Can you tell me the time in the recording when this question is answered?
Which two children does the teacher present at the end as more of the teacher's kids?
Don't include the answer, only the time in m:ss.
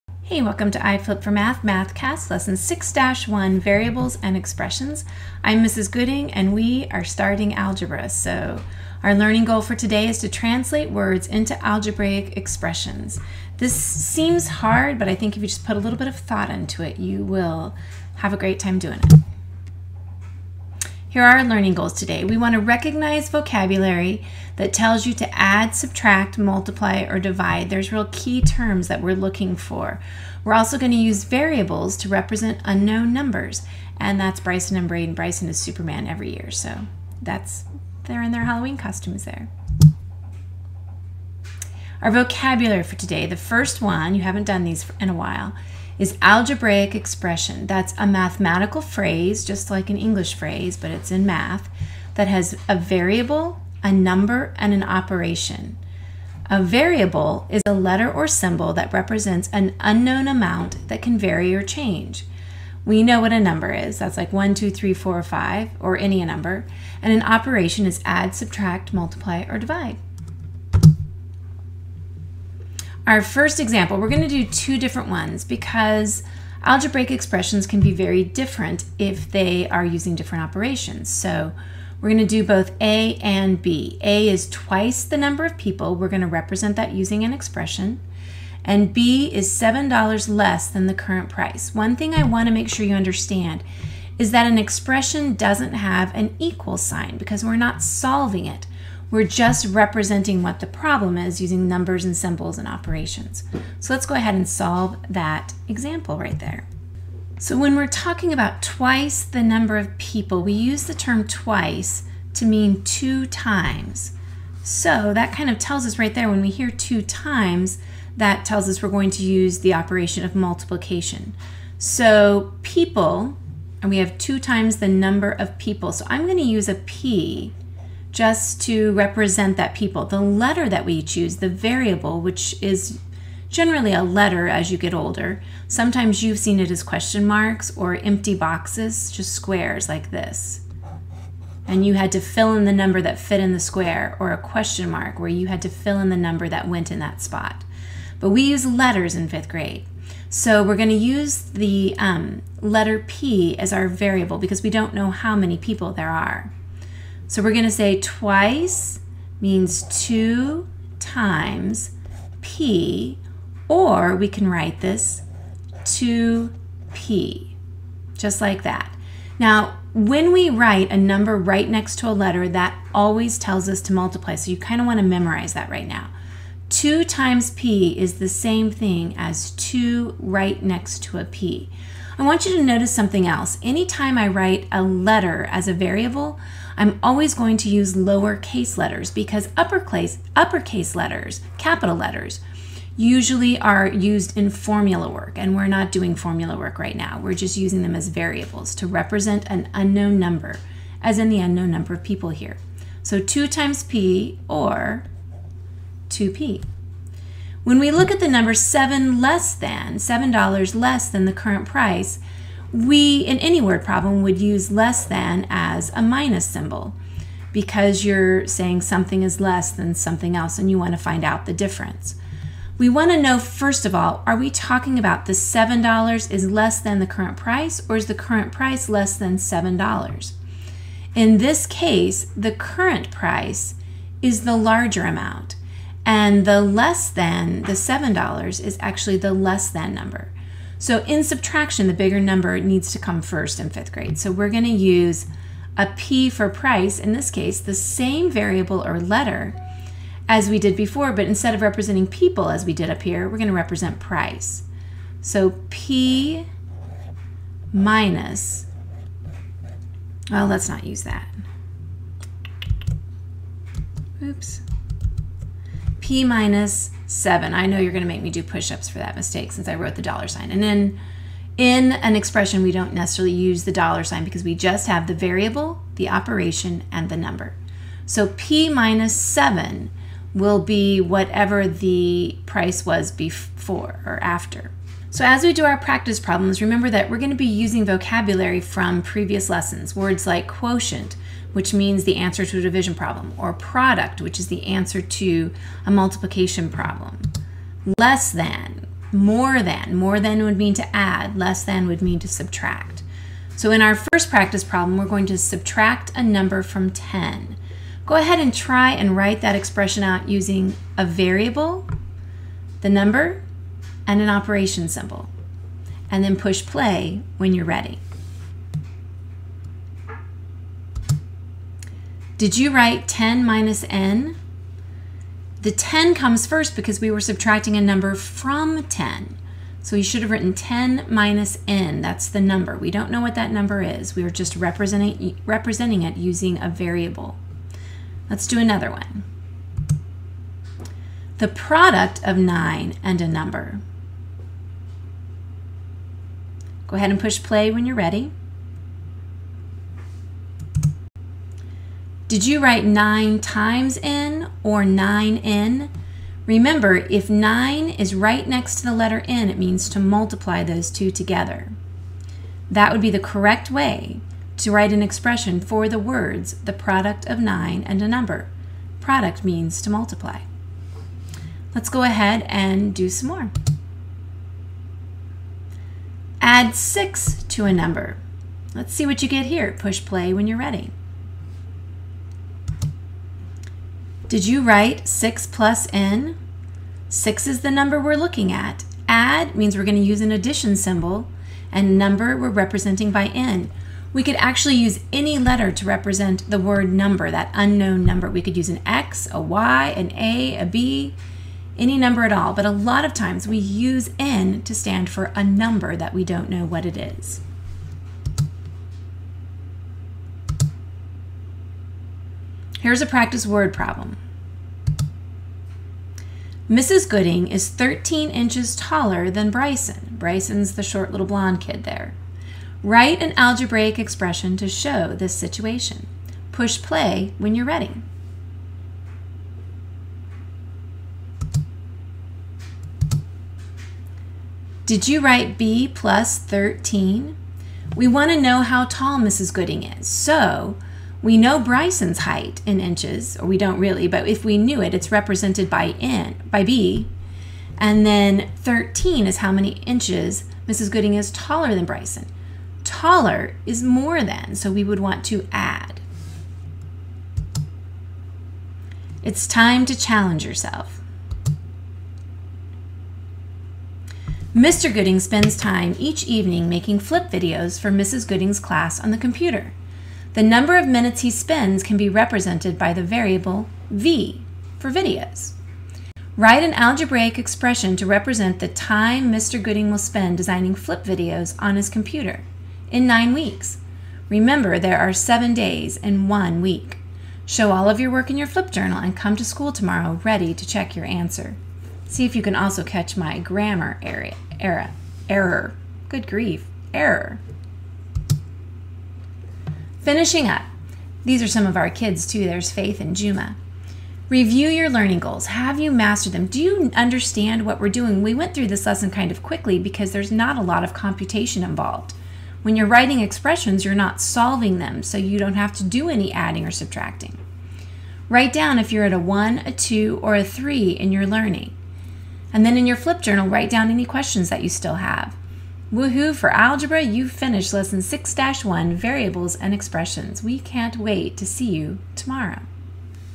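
8:22.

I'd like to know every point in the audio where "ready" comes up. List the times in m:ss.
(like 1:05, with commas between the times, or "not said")
5:17, 5:47, 6:20, 7:07, 8:10.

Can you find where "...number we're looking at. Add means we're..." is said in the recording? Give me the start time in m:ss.
6:27.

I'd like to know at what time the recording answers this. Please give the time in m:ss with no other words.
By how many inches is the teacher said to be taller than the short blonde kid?
6:57.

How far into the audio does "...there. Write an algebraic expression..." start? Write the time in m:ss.
7:01.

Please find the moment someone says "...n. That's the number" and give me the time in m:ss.
5:31.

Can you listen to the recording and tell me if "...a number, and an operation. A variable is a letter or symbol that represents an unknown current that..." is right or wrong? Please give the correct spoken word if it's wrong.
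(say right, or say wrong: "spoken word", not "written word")
wrong: "amount", not "current".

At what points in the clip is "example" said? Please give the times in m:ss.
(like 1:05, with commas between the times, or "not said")
1:13, 1:45.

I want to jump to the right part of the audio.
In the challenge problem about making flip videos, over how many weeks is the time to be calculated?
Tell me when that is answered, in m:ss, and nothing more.
8:03.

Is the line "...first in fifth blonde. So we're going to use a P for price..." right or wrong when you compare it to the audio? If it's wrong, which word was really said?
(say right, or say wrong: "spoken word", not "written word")
wrong: "grade", not "blonde".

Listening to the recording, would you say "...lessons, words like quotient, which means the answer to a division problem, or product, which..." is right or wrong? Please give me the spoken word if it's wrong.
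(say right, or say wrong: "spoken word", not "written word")
right.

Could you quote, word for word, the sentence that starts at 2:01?
So people, and we have two times the number of people.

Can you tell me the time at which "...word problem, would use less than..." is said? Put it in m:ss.
3:33.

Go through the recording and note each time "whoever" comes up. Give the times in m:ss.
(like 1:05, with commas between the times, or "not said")
not said.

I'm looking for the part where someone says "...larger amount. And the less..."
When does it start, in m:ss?
3:54.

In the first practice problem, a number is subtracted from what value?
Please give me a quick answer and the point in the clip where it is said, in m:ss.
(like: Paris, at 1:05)
10, at 5:05.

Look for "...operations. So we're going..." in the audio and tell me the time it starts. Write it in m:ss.
1:20.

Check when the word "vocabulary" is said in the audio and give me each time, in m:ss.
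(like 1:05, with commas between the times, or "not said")
0:23, 0:42, 4:47.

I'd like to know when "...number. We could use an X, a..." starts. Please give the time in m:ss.
6:38.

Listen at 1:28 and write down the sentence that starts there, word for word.
And B is $7 less than the current price.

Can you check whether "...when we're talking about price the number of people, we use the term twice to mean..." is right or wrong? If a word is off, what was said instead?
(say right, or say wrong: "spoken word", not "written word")
wrong: "twice", not "price".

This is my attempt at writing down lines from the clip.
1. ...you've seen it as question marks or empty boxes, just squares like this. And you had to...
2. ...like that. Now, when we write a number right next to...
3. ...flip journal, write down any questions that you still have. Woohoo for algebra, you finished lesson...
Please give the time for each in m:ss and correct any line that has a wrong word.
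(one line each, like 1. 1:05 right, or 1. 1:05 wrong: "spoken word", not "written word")
1. 2:16 right
2. 2:48 right
3. 8:42 right.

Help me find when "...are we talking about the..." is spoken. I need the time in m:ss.
3:44.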